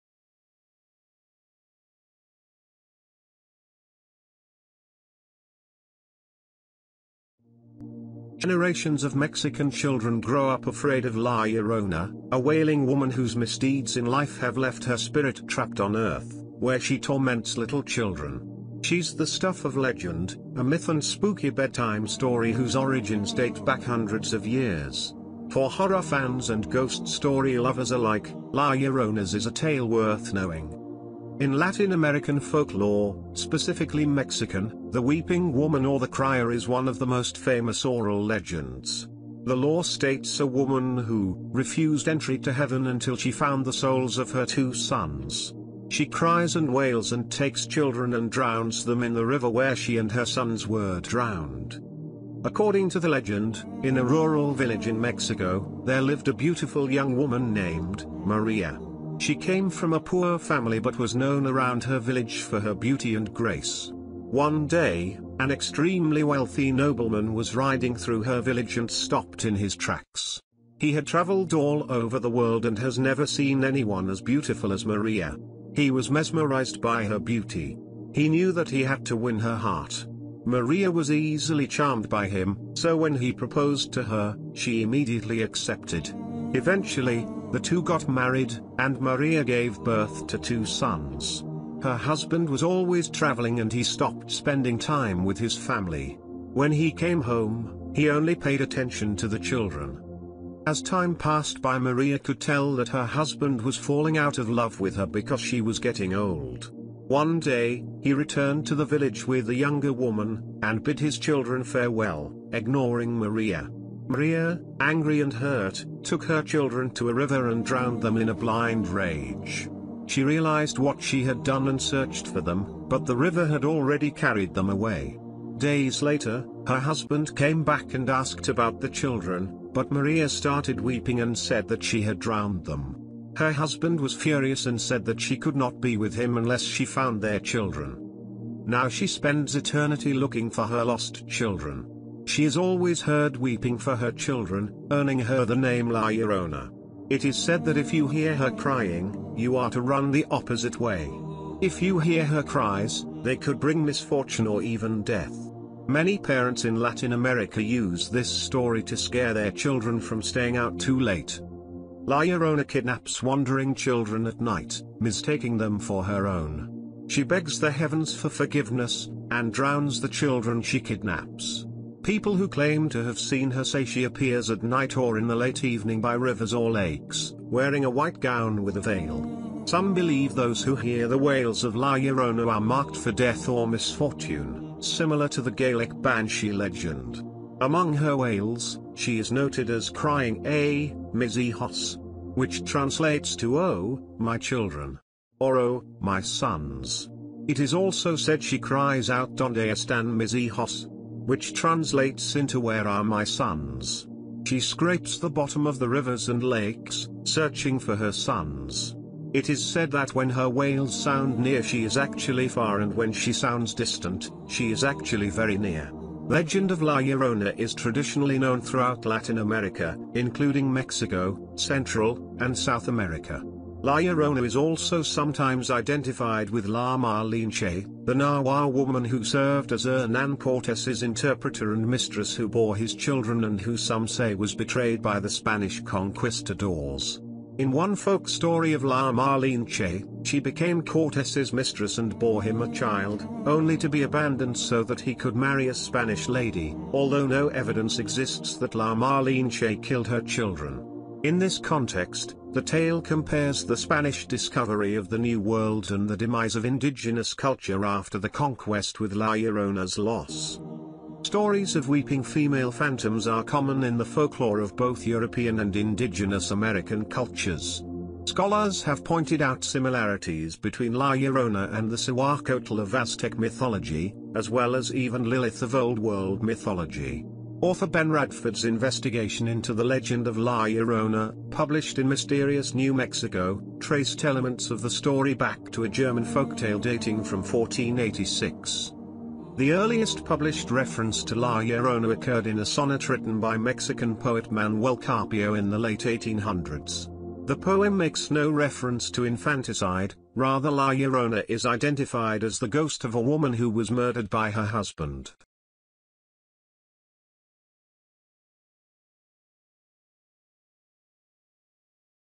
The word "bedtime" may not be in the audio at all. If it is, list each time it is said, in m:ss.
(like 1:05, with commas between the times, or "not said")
0:21.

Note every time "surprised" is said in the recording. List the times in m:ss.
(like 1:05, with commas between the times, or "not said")
not said.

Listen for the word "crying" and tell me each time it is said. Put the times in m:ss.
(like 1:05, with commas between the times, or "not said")
2:28, 3:09.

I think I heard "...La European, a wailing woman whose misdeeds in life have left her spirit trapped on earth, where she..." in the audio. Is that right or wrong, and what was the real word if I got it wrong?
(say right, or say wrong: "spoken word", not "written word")
wrong: "Llorona", not "European".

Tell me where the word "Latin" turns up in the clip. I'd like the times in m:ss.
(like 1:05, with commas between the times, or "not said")
0:31, 2:36, 3:39.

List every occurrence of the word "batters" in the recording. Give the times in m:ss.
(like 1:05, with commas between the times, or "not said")
not said.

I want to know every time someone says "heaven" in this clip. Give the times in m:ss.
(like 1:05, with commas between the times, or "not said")
0:42, 2:47.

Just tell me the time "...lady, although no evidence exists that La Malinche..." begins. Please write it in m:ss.
4:06.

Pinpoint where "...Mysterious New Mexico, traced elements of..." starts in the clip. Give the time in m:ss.
4:42.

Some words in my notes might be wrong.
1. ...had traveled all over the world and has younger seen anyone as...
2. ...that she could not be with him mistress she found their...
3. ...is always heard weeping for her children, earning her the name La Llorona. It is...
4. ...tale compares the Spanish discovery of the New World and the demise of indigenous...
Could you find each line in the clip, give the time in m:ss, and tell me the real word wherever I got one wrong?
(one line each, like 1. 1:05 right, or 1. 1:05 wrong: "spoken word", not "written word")
1. 1:10 wrong: "never", not "younger"
2. 2:15 wrong: "unless", not "mistress"
3. 2:22 right
4. 4:12 right.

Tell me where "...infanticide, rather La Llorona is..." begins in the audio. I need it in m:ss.
4:59.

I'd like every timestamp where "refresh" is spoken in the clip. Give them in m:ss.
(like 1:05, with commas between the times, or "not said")
not said.